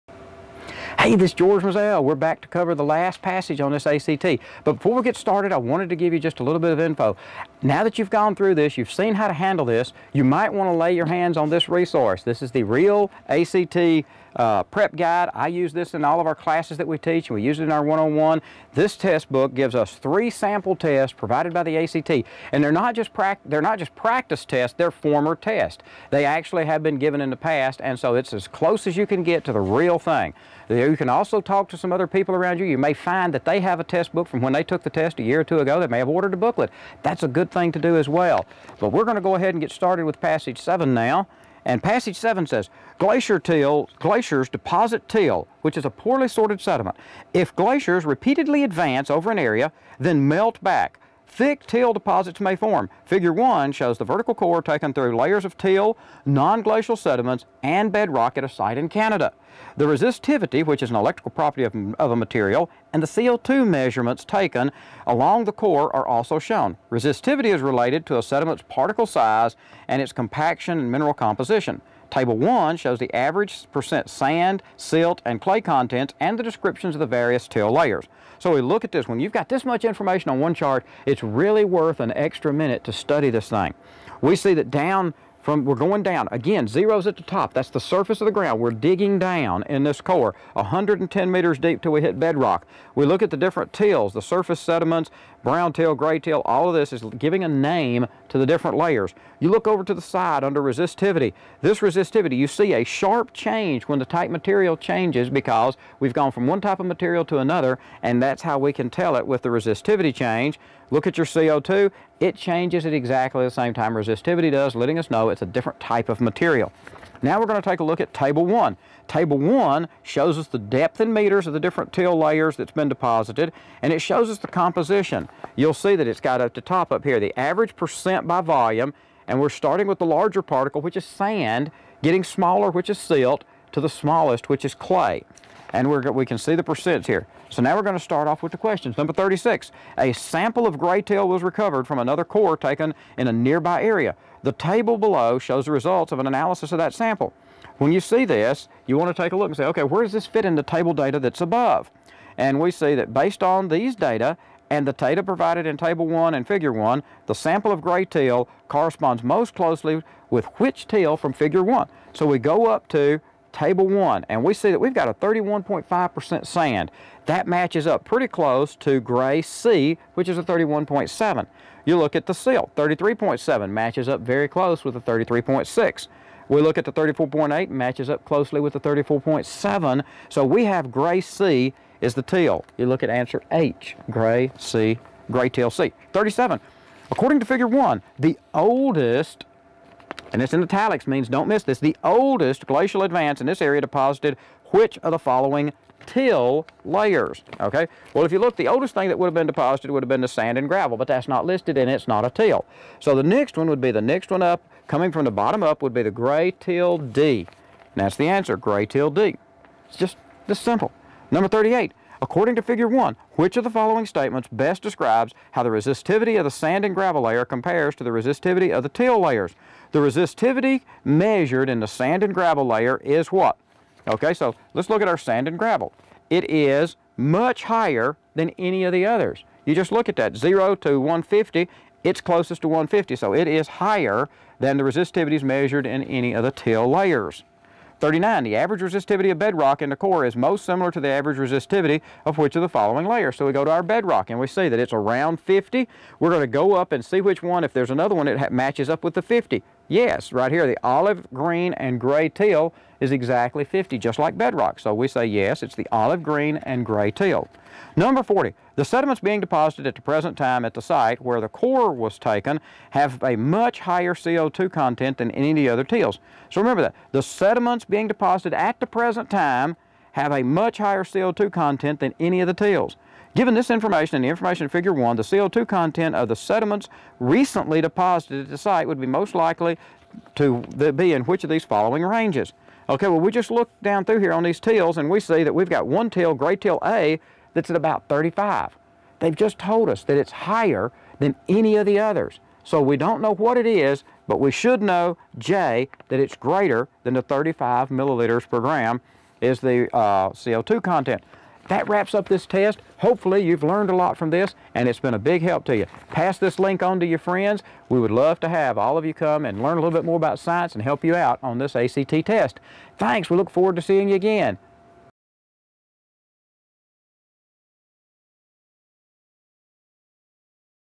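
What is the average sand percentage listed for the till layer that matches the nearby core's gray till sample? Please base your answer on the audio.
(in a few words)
31.7.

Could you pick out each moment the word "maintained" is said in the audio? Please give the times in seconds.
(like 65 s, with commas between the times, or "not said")
not said.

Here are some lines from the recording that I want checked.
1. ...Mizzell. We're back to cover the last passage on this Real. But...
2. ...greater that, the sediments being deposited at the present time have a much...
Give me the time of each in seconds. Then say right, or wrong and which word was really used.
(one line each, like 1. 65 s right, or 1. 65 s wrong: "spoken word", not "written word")
1. 1 s wrong: "ACT", not "Real"
2. 266 s wrong: "remember", not "greater".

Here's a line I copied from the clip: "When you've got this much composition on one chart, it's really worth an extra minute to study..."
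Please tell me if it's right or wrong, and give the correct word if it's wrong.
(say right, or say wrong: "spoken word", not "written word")
wrong: "information", not "composition".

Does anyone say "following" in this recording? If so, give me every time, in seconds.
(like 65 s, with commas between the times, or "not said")
195 s, 213 s, 242 s, 281 s.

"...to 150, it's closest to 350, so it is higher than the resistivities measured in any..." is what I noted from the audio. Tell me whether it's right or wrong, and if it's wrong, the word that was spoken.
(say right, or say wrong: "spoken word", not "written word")
wrong: "150", not "350".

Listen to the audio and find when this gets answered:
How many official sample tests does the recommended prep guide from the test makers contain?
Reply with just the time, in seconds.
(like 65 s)
19 s.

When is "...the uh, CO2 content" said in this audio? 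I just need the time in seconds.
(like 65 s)
299 s.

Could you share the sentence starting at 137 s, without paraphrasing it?
So now we're going to start off with the questions.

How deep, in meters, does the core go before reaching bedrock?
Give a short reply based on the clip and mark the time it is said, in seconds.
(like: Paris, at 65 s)
110, at 90 s.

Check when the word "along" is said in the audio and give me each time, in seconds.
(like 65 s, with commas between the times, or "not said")
65 s.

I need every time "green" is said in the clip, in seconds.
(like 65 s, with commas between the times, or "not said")
251 s, 256 s.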